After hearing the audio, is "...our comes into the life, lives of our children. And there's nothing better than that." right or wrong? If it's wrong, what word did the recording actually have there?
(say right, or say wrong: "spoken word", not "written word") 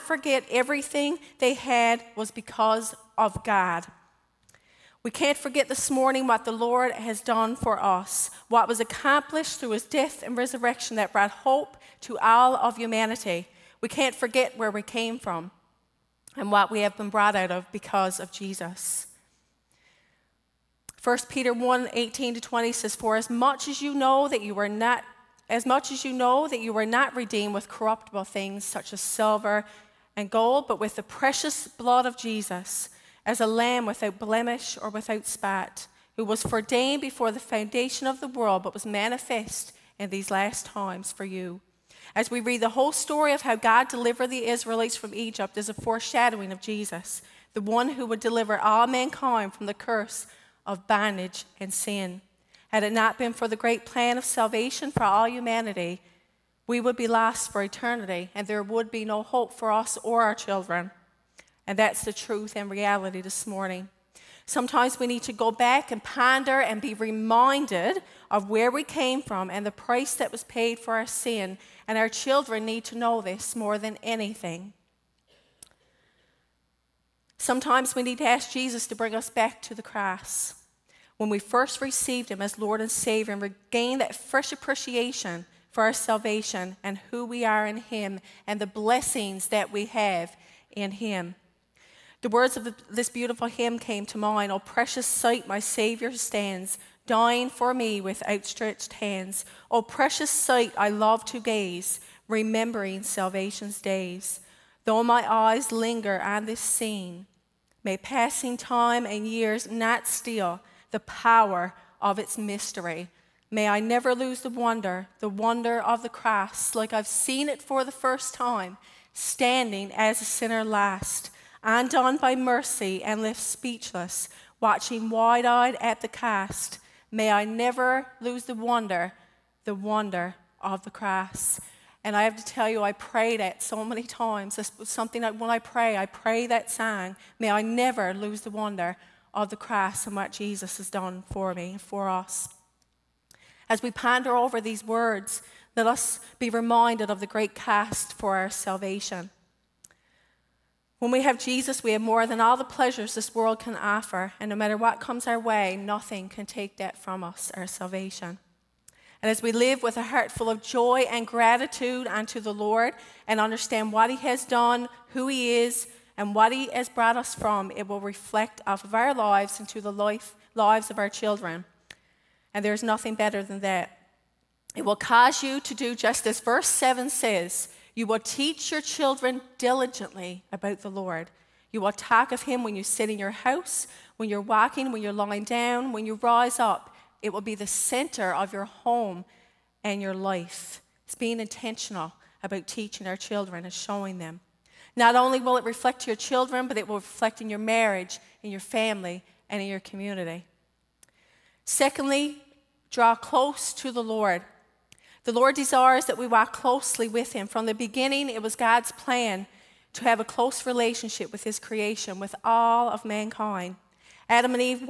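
wrong: "lives", not "comes".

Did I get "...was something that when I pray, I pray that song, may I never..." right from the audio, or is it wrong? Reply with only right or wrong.
right.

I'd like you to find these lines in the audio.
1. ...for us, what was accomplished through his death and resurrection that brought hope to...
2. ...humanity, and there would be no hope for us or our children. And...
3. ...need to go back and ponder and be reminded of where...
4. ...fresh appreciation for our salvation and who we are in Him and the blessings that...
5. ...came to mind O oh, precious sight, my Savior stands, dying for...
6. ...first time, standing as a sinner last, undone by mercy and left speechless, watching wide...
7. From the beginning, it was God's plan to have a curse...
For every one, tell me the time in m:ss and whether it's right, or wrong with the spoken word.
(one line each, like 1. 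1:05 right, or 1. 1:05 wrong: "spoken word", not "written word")
1. 0:07 right
2. 0:57 wrong: "eternity", not "humanity"
3. 1:05 right
4. 1:24 right
5. 1:33 right
6. 1:57 right
7. 3:27 wrong: "close", not "curse".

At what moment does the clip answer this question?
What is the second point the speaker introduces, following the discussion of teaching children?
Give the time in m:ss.
3:22.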